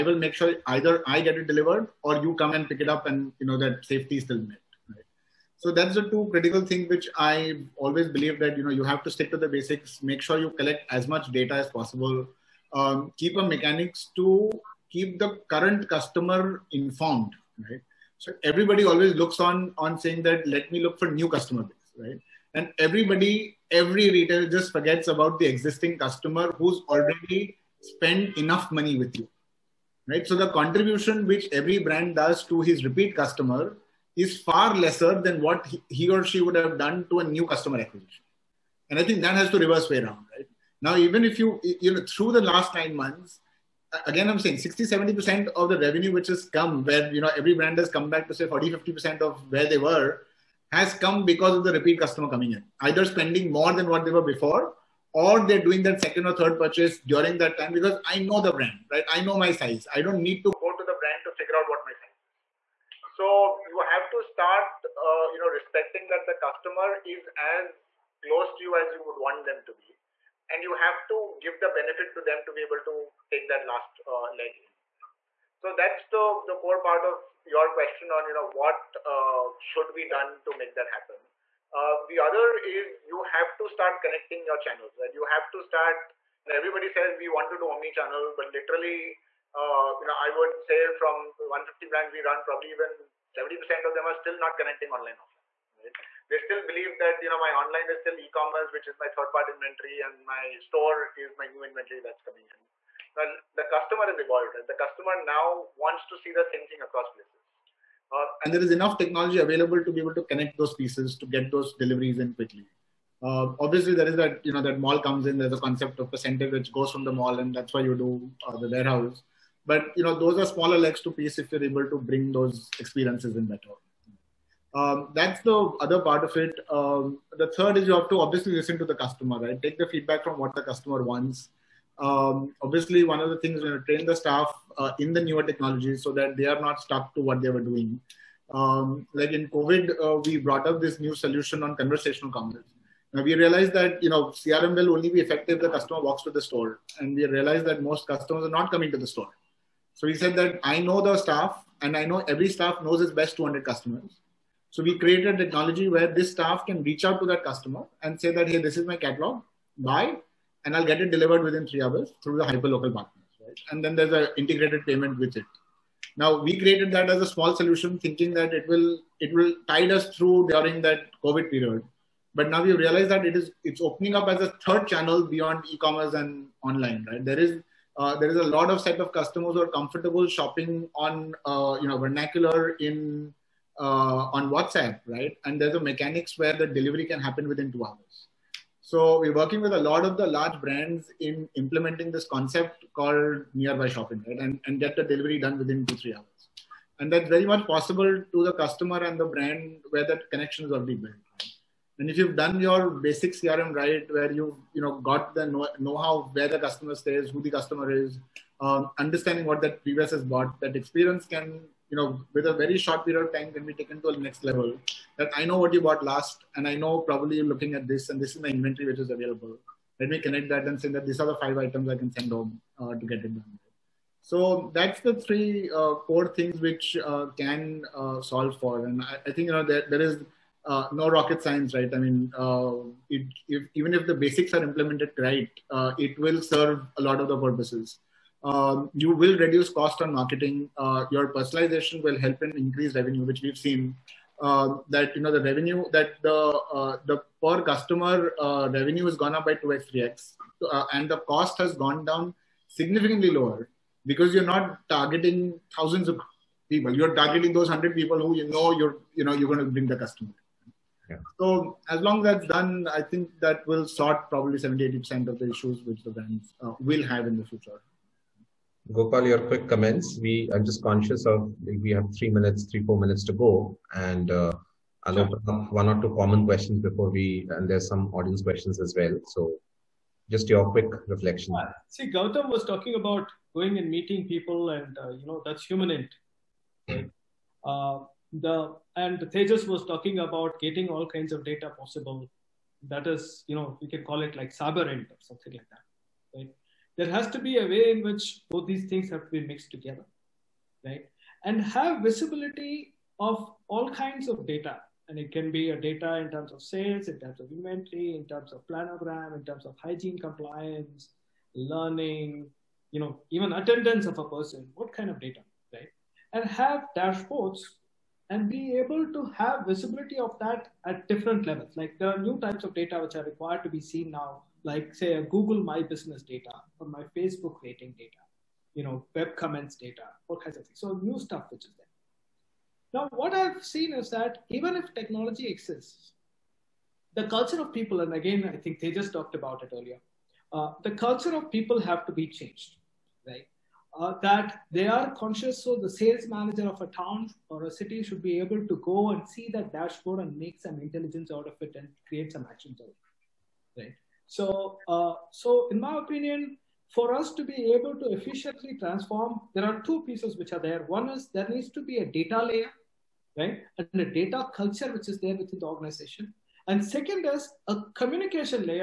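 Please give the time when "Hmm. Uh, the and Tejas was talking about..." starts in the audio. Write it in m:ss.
4:47.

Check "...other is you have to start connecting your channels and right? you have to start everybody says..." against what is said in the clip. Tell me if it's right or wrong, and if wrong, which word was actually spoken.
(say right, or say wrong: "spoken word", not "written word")
right.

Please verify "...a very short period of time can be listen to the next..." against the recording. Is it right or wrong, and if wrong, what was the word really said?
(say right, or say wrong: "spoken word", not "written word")
wrong: "taken", not "listen".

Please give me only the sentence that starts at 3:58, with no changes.
Um, you will reduce cost on marketing.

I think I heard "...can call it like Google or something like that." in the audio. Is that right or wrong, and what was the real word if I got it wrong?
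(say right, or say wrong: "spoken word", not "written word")
wrong: "Saberint", not "Google".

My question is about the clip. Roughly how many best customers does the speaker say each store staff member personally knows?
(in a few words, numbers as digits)
200.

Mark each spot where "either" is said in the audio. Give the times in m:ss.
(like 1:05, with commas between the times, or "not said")
0:00, 0:52.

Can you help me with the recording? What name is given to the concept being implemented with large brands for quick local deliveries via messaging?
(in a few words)
nearby shopping.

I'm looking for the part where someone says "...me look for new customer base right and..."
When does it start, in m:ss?
0:20.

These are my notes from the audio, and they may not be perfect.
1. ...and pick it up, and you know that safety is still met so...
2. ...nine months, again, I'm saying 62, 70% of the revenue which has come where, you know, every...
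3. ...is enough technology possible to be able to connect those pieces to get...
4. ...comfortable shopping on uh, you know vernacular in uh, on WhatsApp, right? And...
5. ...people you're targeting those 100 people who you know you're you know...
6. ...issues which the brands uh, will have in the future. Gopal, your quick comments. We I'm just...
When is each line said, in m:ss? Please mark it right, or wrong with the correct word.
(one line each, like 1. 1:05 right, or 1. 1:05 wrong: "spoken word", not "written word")
1. 0:02 right
2. 0:42 wrong: "60", not "62"
3. 1:48 wrong: "available", not "possible"
4. 2:59 right
5. 4:16 right
6. 4:25 right.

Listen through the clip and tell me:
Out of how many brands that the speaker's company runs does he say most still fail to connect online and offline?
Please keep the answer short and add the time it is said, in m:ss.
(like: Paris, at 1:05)
150, at 1:31.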